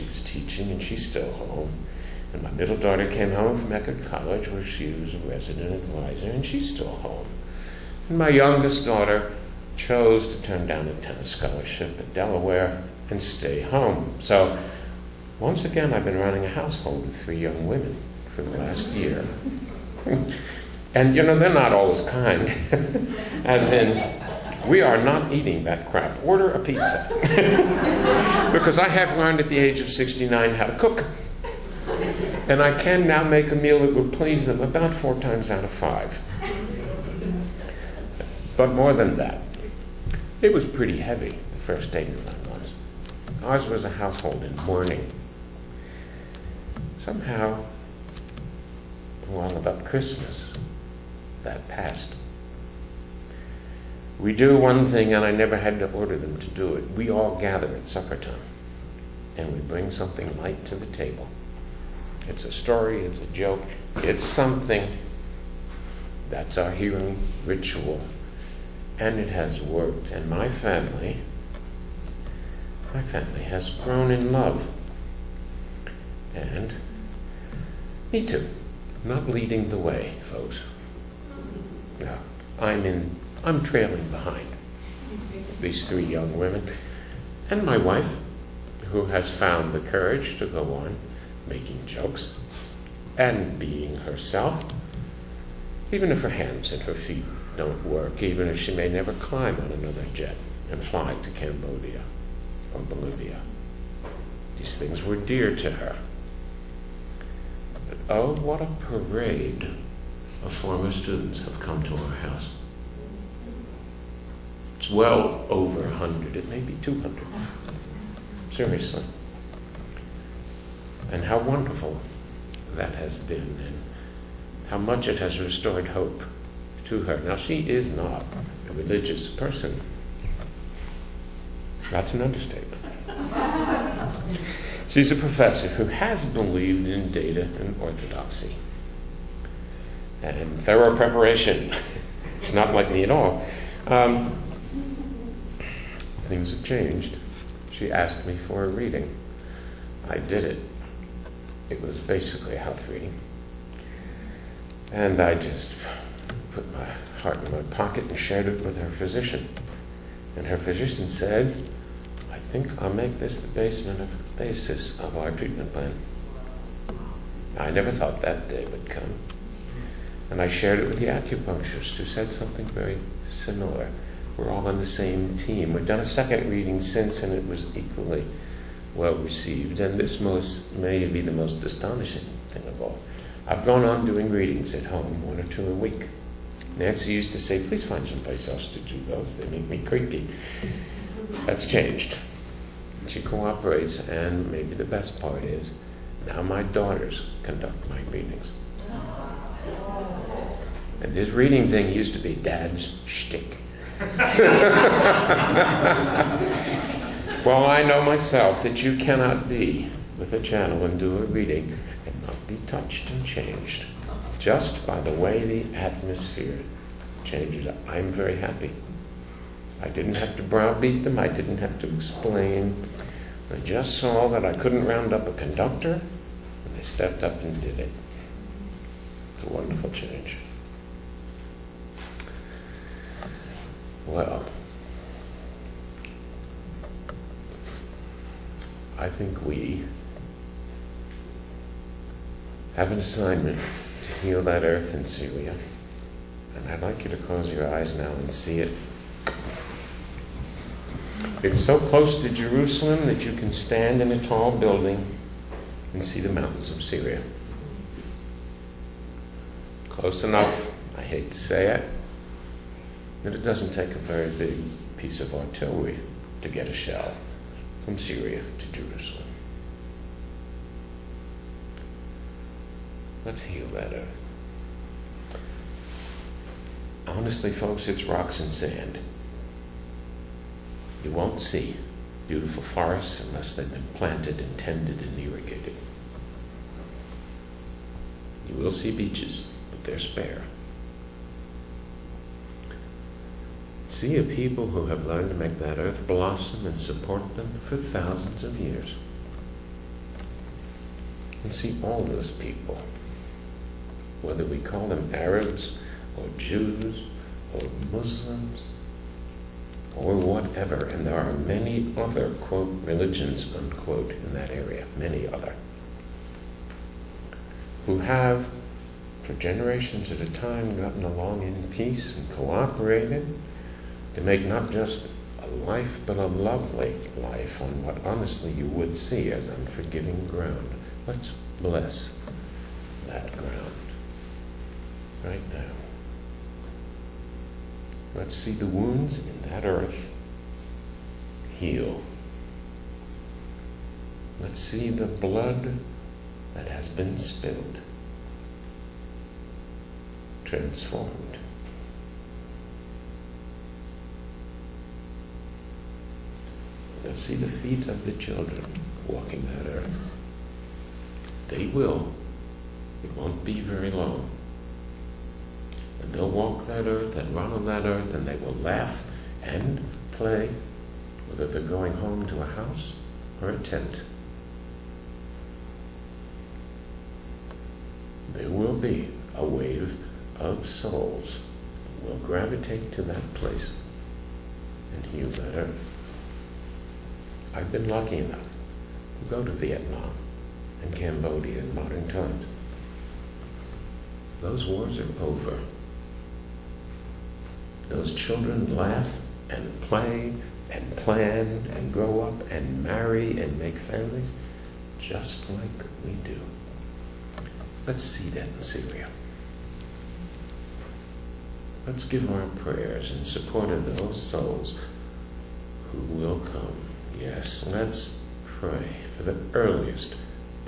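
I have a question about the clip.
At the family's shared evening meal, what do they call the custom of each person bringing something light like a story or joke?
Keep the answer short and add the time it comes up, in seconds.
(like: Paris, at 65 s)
hearing ritual, at 66 s.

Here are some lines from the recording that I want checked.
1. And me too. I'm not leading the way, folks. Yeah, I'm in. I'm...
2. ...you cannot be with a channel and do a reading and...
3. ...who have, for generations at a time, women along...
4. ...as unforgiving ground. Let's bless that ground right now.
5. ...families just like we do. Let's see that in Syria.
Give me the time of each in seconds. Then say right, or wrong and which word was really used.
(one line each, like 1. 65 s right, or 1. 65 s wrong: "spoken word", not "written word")
1. 76 s right
2. 208 s right
3. 317 s wrong: "gotten", not "women"
4. 329 s right
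5. 403 s right.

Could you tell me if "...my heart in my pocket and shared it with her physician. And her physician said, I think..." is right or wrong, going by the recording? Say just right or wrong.
right.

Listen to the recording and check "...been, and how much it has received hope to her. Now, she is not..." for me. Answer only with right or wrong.
wrong.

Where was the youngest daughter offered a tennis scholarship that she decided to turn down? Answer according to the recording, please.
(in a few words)
Delaware.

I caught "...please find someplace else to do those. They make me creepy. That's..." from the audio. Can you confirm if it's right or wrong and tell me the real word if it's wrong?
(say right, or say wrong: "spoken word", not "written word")
right.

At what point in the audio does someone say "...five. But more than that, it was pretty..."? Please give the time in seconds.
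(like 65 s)
35 s.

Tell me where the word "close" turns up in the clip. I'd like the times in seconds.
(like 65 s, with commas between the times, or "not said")
247 s, 251 s, 259 s.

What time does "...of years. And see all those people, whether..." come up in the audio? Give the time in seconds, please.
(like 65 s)
298 s.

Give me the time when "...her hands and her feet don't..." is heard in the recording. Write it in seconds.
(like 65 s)
96 s.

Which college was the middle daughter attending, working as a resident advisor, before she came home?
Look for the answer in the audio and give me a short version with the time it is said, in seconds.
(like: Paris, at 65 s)
Eckerd College, at 3 s.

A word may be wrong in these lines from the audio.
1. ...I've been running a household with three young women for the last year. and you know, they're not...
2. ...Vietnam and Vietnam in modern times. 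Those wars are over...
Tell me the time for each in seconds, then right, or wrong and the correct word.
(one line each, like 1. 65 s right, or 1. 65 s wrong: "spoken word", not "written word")
1. 15 s right
2. 389 s wrong: "Cambodia", not "Vietnam".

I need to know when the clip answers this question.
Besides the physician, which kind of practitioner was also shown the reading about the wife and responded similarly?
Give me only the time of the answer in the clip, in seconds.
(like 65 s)
171 s.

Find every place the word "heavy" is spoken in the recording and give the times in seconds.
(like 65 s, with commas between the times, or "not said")
40 s.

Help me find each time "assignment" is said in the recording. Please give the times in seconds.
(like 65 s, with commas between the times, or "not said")
242 s.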